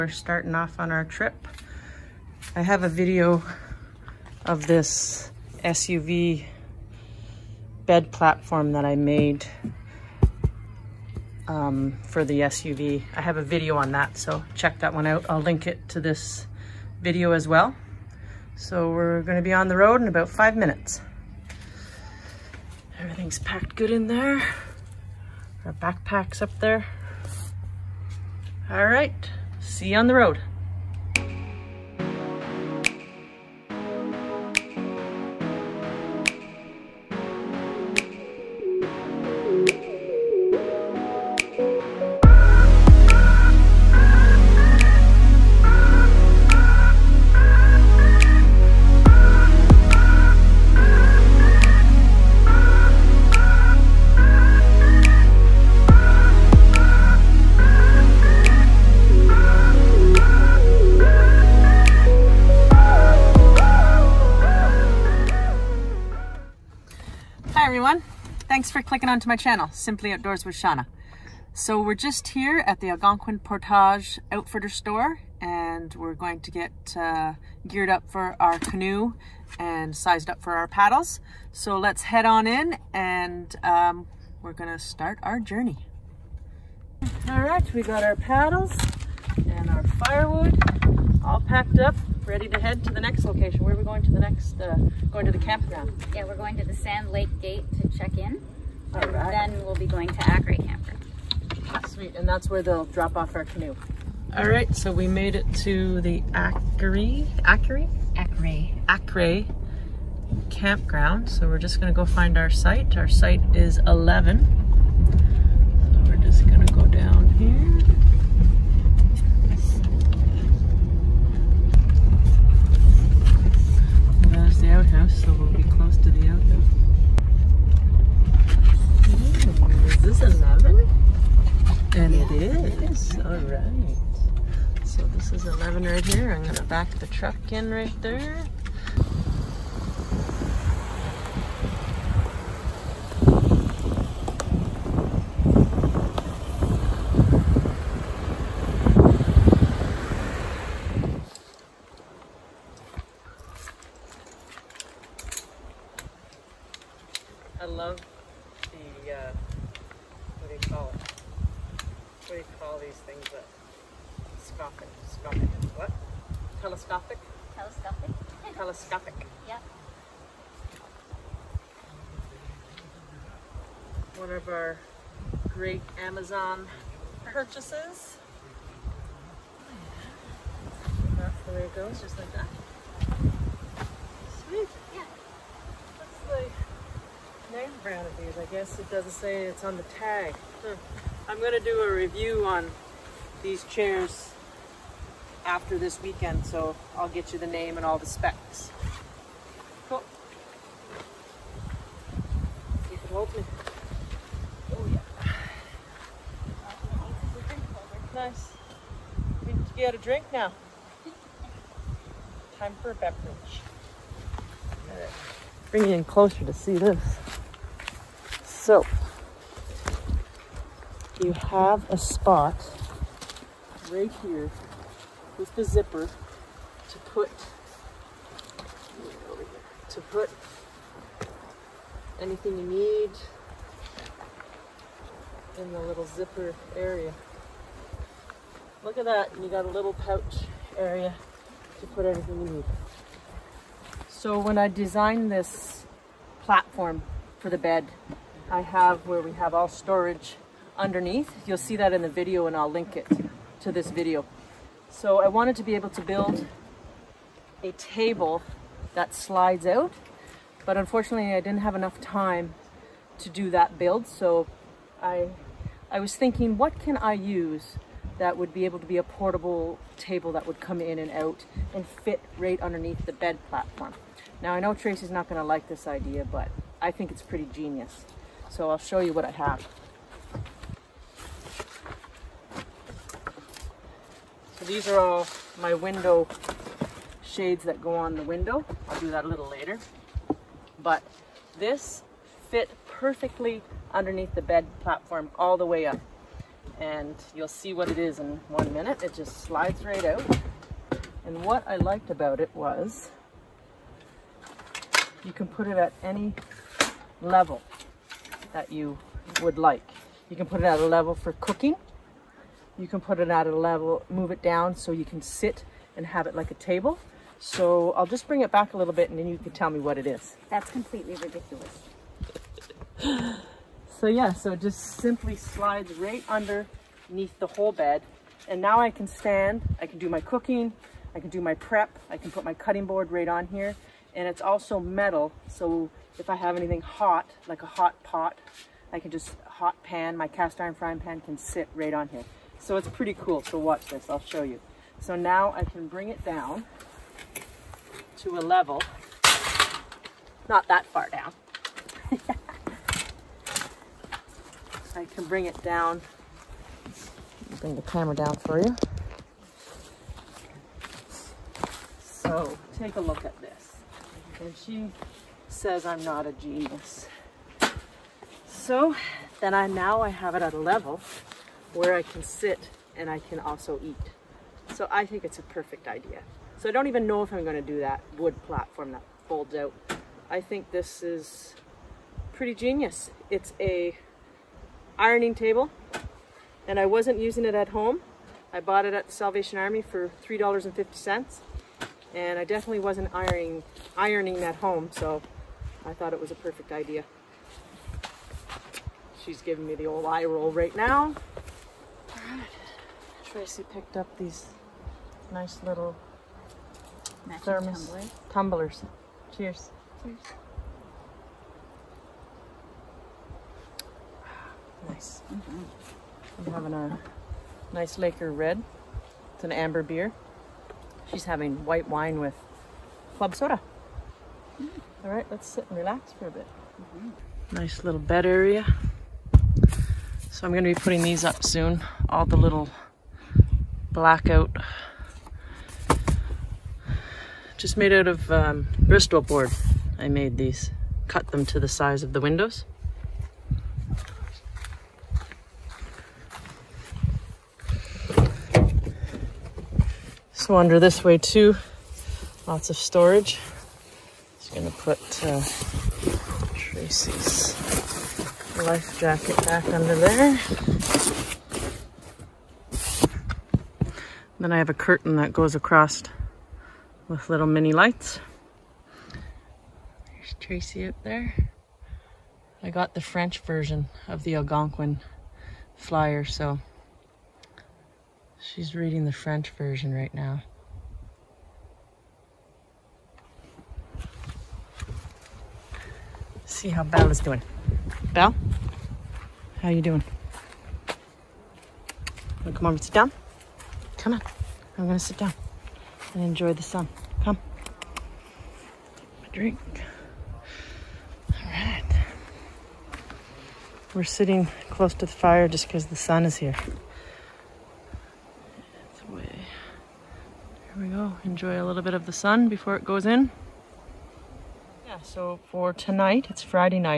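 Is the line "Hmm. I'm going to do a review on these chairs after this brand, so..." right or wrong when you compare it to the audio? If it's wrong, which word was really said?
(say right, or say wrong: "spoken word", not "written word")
wrong: "weekend", not "brand".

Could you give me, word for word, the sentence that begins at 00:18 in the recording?
So we're gonna be on the road in about five minutes.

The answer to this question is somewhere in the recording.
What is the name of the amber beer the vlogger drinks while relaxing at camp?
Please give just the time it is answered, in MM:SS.
06:58.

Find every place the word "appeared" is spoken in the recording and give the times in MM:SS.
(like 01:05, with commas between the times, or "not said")
not said.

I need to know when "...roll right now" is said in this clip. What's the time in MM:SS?
06:40.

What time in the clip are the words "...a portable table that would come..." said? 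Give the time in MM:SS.
04:28.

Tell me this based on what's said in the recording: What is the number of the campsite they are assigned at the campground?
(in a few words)
11.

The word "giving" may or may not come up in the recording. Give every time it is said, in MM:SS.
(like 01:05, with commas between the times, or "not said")
06:39.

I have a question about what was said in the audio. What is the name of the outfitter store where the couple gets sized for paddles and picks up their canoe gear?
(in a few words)
Algonquin Portage Outfitter.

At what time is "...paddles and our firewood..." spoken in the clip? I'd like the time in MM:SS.
01:28.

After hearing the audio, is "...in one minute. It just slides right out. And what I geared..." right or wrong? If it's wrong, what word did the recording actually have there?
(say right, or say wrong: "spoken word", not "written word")
wrong: "liked", not "geared".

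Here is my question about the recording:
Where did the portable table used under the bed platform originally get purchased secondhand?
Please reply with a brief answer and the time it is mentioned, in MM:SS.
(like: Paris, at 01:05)
Salvation Army, at 06:29.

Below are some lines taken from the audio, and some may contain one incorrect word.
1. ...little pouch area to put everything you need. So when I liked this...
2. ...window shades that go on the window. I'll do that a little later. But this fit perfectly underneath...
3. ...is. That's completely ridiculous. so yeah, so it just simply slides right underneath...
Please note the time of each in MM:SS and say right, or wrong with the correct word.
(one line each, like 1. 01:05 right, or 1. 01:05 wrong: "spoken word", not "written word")
1. 03:59 wrong: "designed", not "liked"
2. 04:45 right
3. 05:20 right.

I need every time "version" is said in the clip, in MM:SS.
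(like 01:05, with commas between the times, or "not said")
07:53, 07:59.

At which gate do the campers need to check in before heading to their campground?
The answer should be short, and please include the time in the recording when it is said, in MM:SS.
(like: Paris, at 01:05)
Sand Lake Gate, at 01:36.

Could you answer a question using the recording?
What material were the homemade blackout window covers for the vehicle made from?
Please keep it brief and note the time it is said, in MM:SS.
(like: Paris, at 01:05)
Bristol board, at 07:18.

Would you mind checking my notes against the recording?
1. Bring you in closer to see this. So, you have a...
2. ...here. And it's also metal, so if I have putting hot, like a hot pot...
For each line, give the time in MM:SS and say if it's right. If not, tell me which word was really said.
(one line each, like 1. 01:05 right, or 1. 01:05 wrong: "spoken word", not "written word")
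1. 03:35 right
2. 05:33 wrong: "anything", not "putting".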